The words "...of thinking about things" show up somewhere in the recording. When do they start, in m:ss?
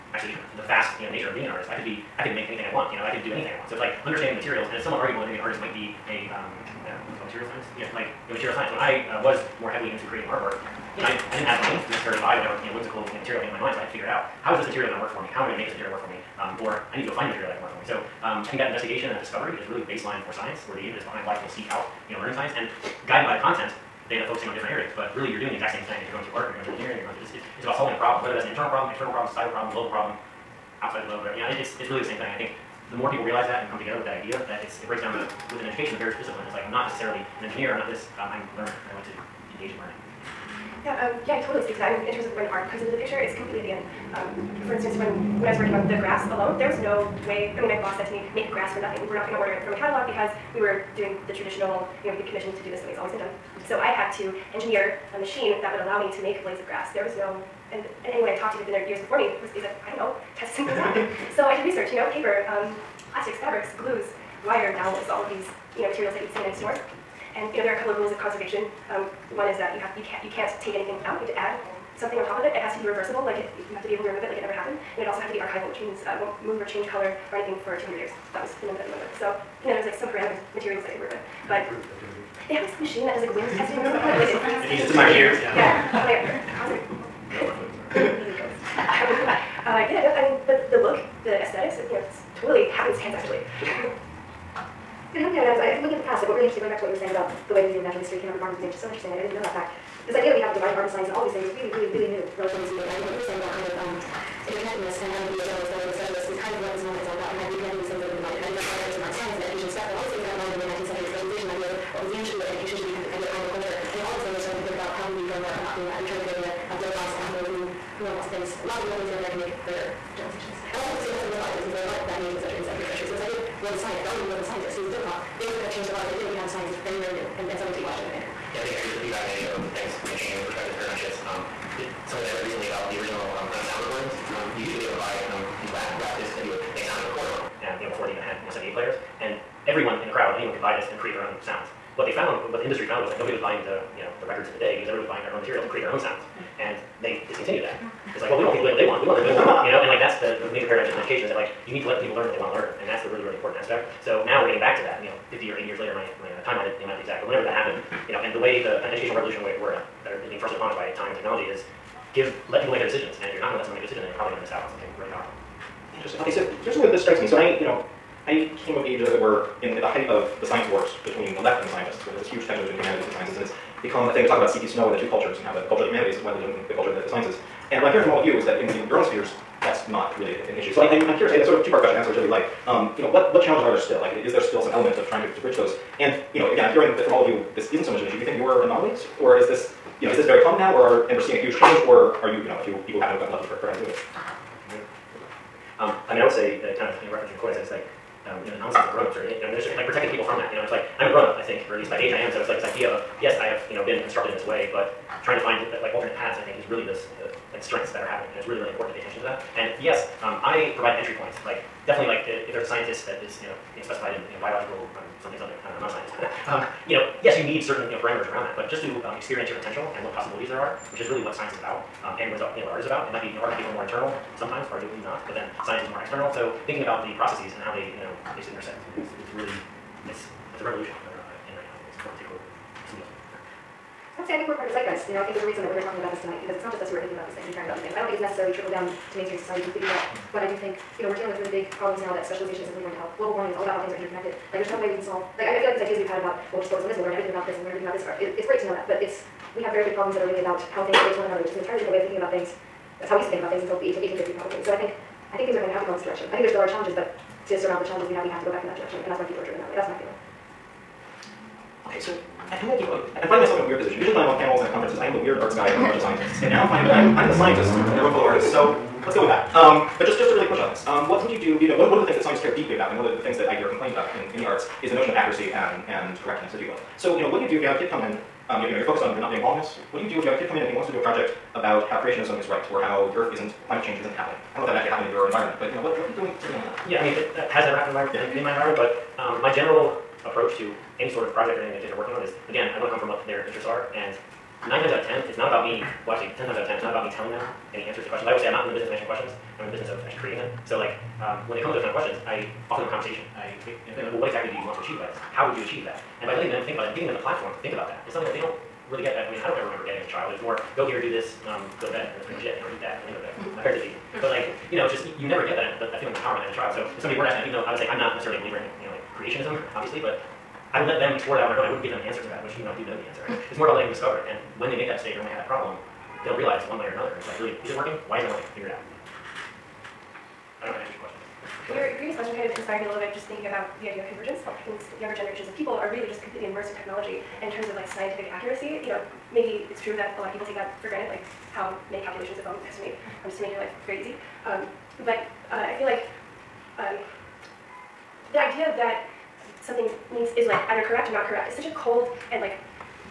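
4:11.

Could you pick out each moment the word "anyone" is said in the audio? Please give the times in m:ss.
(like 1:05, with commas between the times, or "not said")
0:58, 2:20.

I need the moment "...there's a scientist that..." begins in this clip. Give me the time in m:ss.
3:32.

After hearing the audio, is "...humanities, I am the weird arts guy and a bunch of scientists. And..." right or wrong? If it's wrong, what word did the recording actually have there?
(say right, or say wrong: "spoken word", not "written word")
wrong: "conferences", not "humanities".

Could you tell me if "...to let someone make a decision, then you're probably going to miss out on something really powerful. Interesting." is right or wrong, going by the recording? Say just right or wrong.
right.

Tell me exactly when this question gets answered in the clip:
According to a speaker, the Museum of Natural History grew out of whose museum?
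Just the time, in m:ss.
1:38.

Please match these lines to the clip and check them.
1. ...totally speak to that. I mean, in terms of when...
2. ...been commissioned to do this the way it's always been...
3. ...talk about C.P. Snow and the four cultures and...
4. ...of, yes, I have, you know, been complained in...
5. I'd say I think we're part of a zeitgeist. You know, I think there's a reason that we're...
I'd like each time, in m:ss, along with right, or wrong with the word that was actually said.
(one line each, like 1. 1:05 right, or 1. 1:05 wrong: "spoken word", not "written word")
1. 0:41 right
2. 0:52 right
3. 2:54 wrong: "two", not "four"
4. 3:22 wrong: "constructed", not "complained"
5. 3:54 right.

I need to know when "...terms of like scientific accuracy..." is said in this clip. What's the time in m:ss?
5:37.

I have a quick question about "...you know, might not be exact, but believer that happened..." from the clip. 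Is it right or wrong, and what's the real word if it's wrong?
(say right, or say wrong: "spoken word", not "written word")
wrong: "whenever", not "believer".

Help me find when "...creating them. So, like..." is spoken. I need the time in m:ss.
5:00.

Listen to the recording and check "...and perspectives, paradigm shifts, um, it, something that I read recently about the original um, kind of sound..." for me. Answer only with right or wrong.
right.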